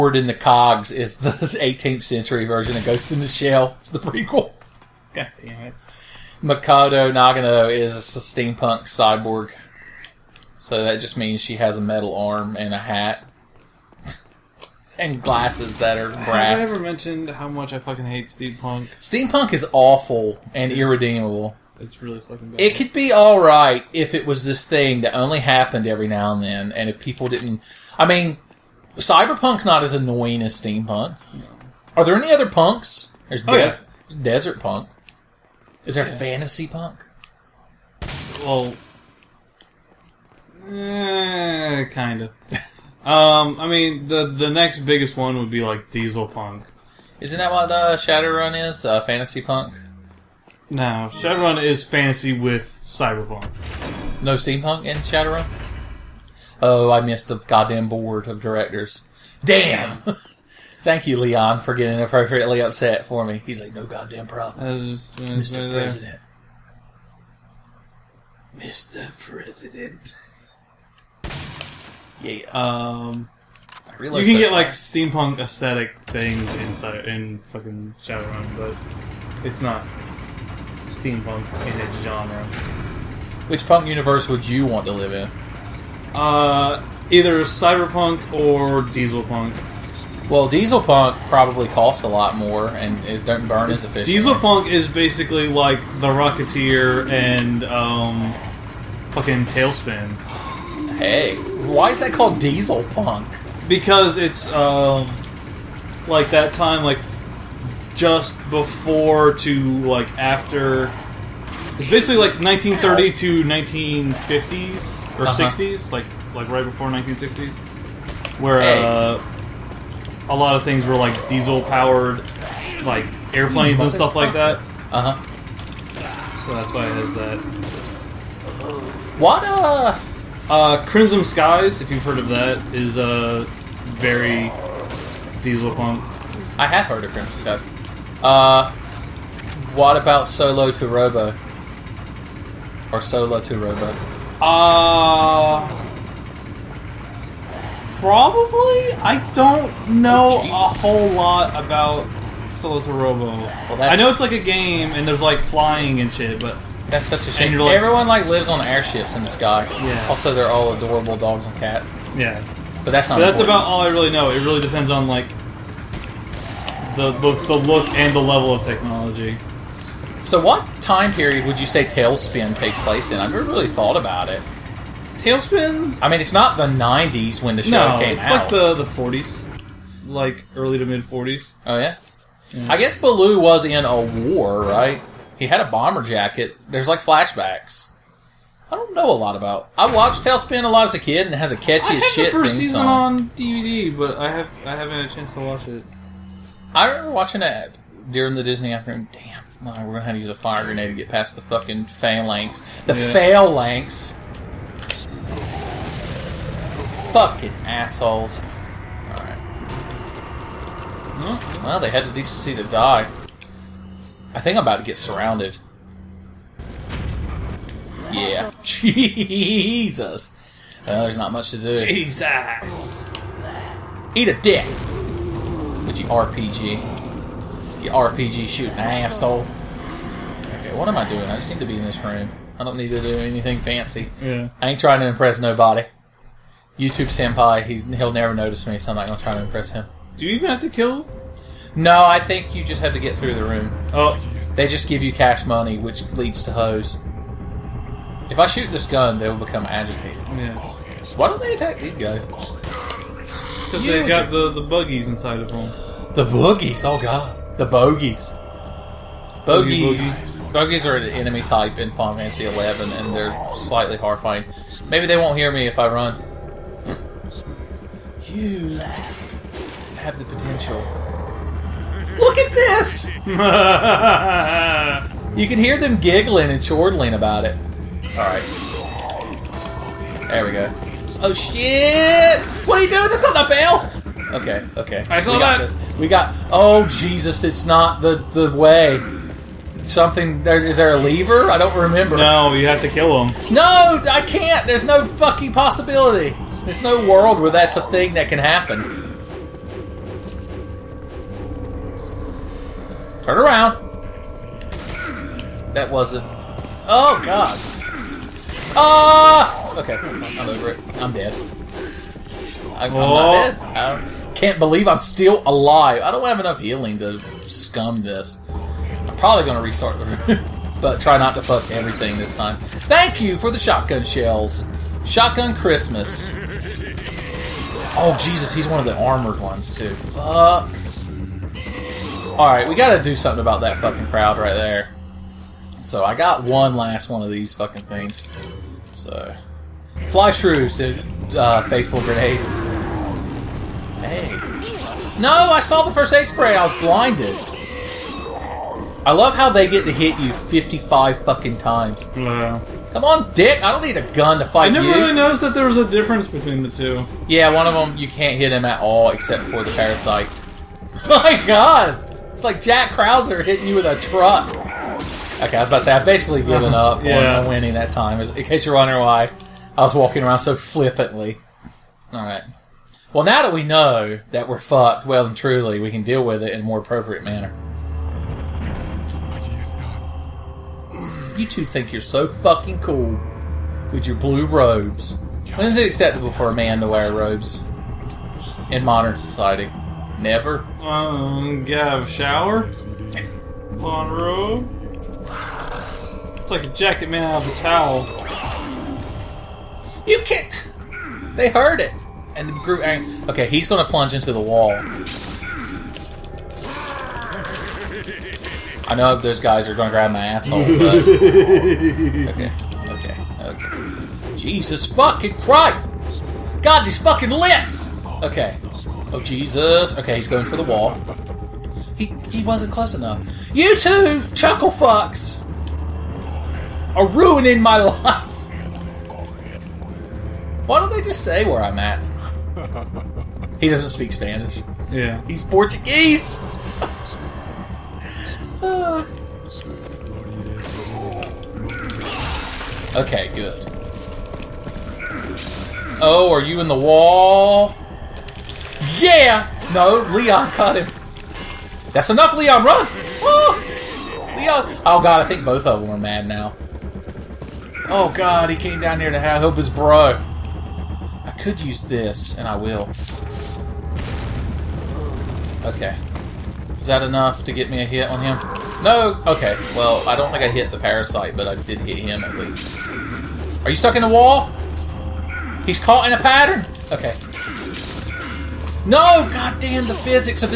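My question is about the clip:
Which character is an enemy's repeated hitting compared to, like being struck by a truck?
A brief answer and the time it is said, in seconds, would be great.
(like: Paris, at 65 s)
Jack Krauser, at 362 s.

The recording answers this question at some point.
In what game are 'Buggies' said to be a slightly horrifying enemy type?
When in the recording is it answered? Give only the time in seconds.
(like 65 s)
261 s.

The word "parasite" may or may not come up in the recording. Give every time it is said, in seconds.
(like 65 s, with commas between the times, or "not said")
359 s, 470 s.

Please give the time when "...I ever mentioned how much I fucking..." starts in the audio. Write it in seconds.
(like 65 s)
16 s.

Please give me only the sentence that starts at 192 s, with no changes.
on DVD, but I have I haven't had a chance to watch it.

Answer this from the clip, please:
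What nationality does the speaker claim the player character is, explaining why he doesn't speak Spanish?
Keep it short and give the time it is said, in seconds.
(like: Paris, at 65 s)
Portuguese, at 435 s.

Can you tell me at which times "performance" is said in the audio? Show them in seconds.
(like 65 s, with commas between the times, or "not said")
not said.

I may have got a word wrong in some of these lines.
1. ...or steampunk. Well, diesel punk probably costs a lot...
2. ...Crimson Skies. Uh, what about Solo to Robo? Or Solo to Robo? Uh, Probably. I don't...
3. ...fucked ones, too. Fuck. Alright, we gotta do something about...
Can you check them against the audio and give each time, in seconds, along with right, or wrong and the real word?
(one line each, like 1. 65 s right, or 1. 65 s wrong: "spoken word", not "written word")
1. 88 s wrong: "dieselpunk", not "steampunk"
2. 137 s right
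3. 328 s wrong: "armored", not "fucked".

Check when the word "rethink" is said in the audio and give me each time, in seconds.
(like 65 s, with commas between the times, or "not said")
not said.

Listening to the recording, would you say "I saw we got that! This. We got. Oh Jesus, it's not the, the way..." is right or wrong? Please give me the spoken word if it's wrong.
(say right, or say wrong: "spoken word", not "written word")
right.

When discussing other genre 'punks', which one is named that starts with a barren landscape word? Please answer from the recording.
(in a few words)
Desert punk.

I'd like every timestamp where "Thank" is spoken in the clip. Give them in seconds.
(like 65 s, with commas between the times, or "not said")
60 s, 322 s.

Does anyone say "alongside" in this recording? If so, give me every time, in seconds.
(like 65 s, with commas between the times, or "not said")
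not said.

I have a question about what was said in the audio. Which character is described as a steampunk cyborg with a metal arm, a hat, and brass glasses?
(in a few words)
Mikado Nagano.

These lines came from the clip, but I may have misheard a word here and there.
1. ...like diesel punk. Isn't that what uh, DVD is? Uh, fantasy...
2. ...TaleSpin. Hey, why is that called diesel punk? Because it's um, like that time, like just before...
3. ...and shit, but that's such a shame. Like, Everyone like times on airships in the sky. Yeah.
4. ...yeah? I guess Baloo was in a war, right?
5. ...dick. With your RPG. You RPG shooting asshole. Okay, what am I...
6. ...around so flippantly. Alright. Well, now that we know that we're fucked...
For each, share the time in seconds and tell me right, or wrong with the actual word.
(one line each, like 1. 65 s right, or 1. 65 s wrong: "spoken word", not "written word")
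1. 45 s wrong: "Shadowrun", not "DVD"
2. 99 s right
3. 155 s wrong: "lives", not "times"
4. 181 s right
5. 224 s right
6. 370 s right.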